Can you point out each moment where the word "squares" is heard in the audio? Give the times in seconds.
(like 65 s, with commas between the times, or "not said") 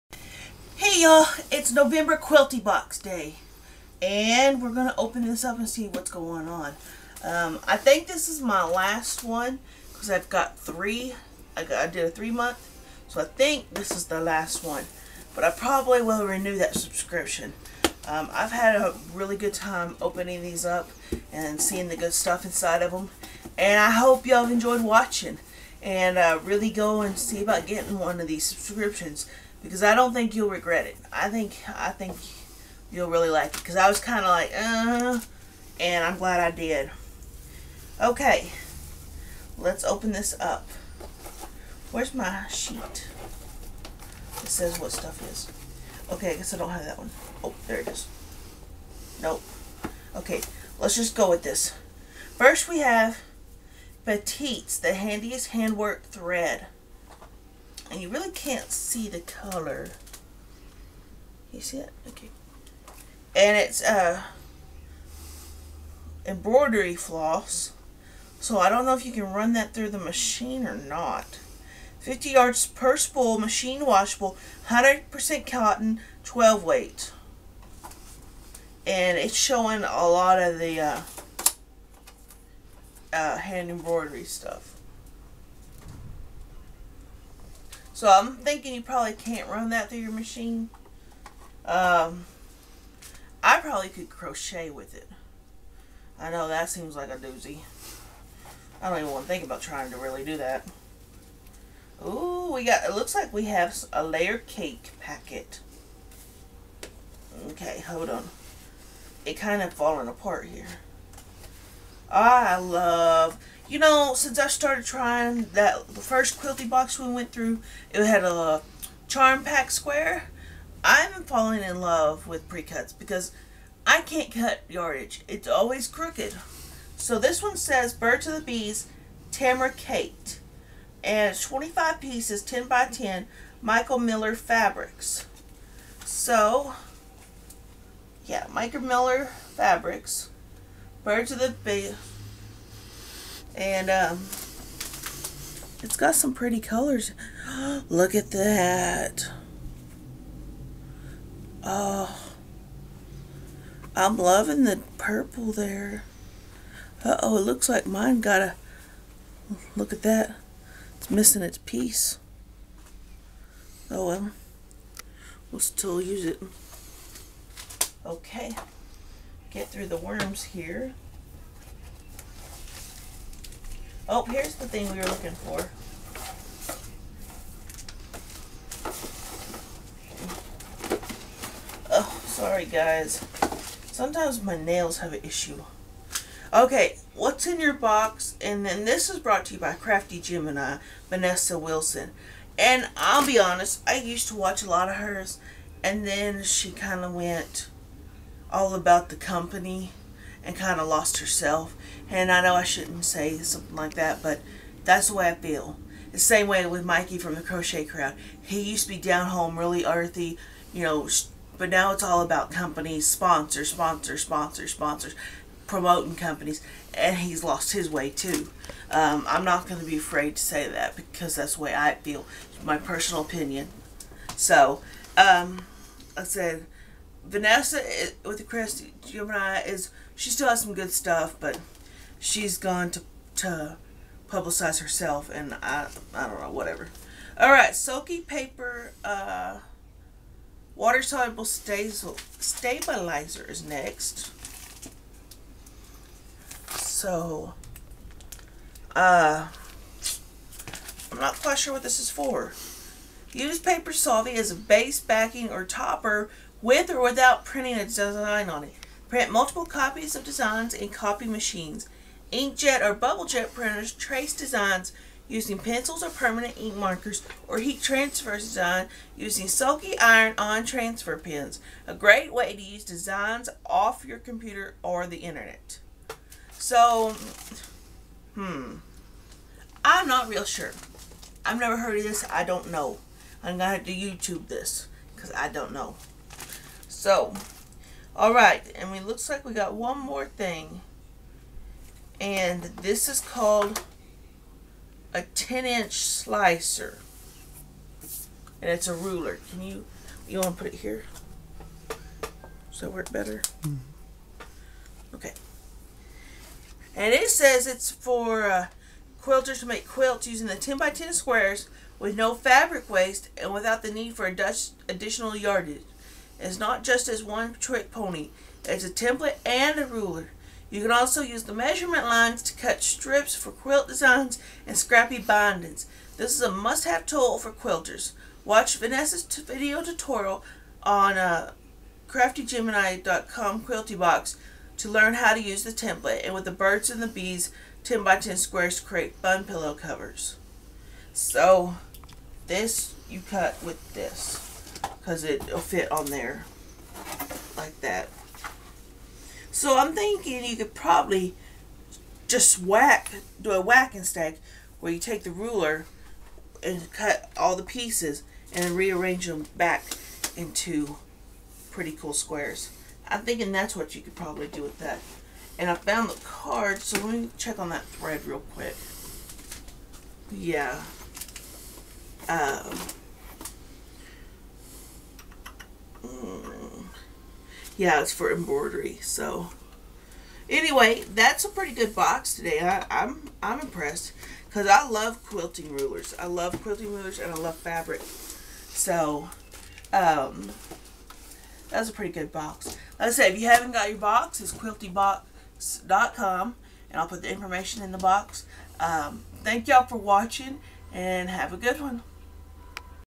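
119 s, 311 s, 338 s, 362 s.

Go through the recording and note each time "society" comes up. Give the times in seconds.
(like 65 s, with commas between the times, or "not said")
not said.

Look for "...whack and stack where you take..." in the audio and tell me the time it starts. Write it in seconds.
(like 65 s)
353 s.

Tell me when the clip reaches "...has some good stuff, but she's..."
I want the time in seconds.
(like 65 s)
230 s.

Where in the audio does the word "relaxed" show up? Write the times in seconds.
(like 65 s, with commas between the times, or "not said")
not said.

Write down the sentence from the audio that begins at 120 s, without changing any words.
i am falling in love with pre-cuts because I can't cut yardage.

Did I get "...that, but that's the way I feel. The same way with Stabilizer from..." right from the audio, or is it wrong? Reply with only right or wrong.
wrong.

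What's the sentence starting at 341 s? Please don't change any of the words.
So this you cut with this because it'll fit on there like that.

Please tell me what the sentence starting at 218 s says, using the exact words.
Um, I'm not going to be afraid to say that because that's the way I feel, my personal opinion.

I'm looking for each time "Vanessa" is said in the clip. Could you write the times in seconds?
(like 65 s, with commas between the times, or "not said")
191 s, 227 s, 328 s.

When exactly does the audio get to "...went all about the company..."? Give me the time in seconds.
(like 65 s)
197 s.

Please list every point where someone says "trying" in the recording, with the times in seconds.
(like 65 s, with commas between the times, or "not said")
99 s, 114 s.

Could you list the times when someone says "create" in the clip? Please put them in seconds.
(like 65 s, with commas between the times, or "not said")
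338 s.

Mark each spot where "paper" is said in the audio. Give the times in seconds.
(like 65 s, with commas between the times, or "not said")
238 s, 253 s.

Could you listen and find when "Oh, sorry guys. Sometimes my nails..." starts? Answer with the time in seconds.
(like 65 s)
181 s.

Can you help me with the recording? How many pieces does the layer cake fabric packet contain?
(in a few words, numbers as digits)
25.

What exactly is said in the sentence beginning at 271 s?
A great way to use designs off your computer or the internet.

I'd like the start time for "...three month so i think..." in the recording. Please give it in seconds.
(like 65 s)
12 s.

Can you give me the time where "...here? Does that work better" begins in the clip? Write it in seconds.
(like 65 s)
300 s.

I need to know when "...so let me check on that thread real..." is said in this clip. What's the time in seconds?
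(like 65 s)
366 s.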